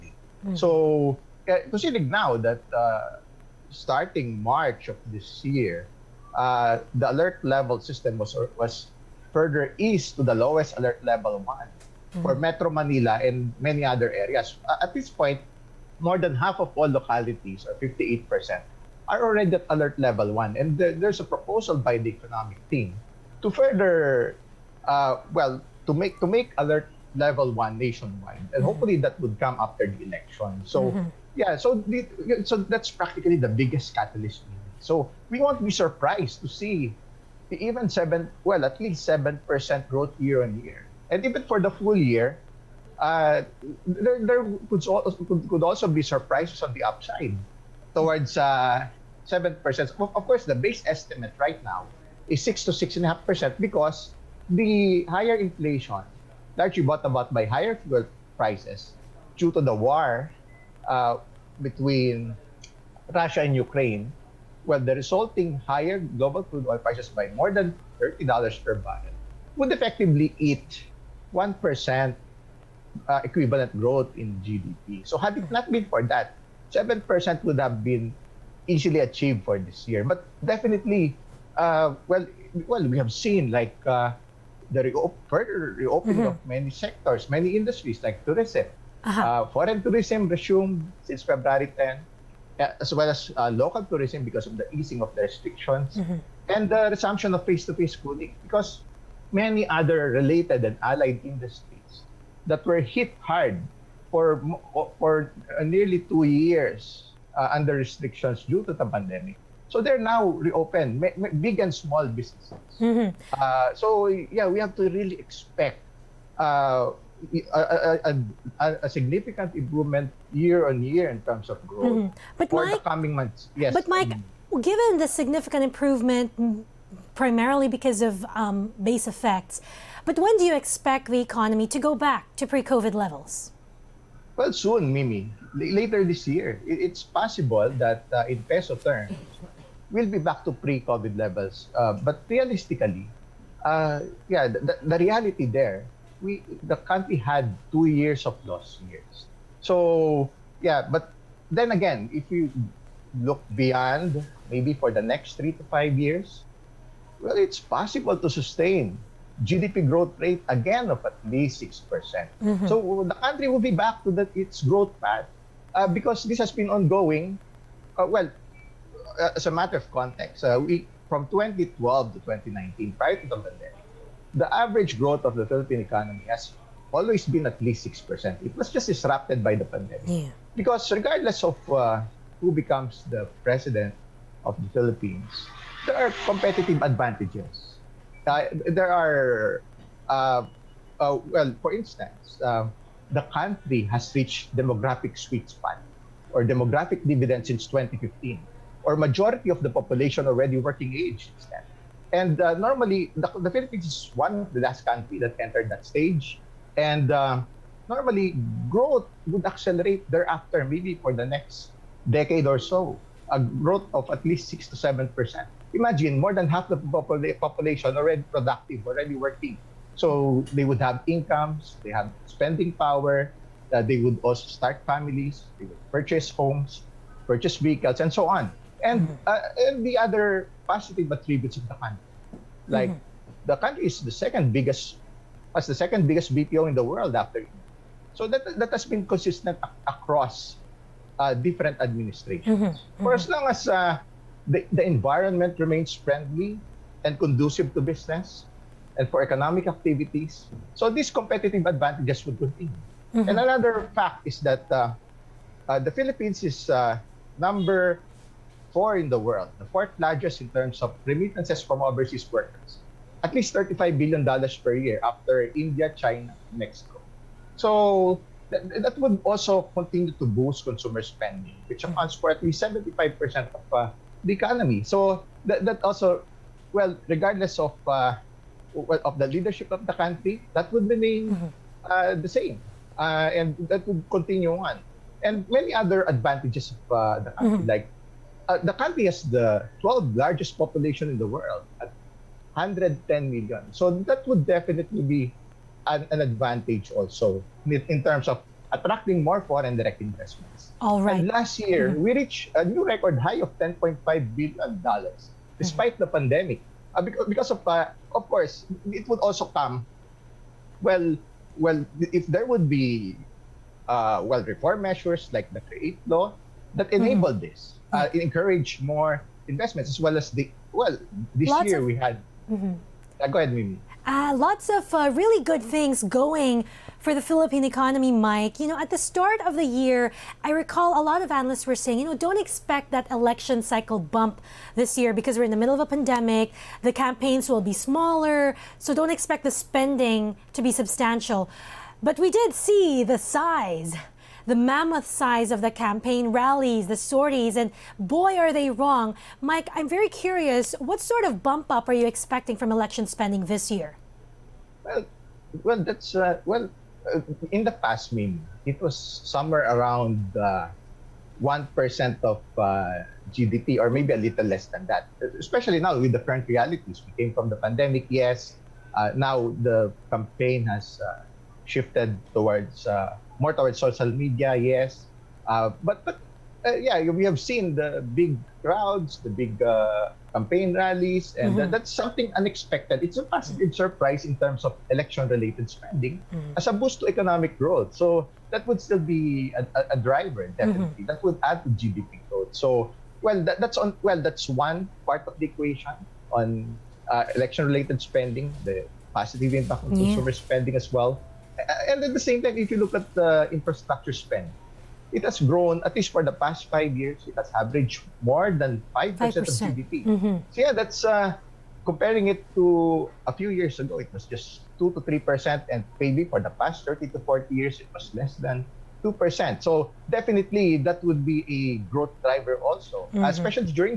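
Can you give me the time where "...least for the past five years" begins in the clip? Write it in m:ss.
6:45.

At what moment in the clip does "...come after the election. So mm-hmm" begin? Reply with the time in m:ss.
0:29.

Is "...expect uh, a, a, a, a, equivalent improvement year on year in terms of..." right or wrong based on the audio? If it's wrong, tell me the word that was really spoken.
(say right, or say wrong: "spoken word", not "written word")
wrong: "significant", not "equivalent".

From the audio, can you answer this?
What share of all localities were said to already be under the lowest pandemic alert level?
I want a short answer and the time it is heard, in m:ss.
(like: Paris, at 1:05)
58%, at 0:17.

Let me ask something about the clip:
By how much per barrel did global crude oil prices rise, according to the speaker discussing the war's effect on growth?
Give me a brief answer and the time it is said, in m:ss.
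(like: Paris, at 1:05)
more than $30, at 1:07.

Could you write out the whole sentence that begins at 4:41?
uh, the same, uh, and that would continue on.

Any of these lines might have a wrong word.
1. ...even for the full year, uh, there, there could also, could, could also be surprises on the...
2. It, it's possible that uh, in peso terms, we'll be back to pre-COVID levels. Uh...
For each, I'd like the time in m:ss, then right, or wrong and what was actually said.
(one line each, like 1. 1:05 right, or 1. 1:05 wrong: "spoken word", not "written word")
1. 0:41 right
2. 2:16 right.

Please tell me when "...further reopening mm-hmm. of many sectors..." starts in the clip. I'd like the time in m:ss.
1:25.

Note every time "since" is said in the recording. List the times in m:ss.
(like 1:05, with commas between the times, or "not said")
1:31, 3:17.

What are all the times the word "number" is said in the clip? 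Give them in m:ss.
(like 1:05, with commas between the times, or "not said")
4:17.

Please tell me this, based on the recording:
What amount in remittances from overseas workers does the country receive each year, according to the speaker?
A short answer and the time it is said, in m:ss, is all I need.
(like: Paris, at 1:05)
$35 billion, at 4:23.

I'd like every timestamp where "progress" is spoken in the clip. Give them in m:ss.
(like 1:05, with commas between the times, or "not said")
not said.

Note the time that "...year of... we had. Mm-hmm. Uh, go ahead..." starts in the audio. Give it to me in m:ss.
5:21.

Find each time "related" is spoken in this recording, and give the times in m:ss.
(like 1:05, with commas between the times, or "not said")
1:40, 6:24, 6:37.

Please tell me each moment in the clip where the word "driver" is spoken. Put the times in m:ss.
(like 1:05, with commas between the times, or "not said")
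6:29, 7:02.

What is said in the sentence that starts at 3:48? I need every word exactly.
And, uh, and the other positive attributes of the country.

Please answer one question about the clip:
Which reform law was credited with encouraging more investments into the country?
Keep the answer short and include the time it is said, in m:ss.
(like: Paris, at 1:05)
Create Law, at 5:15.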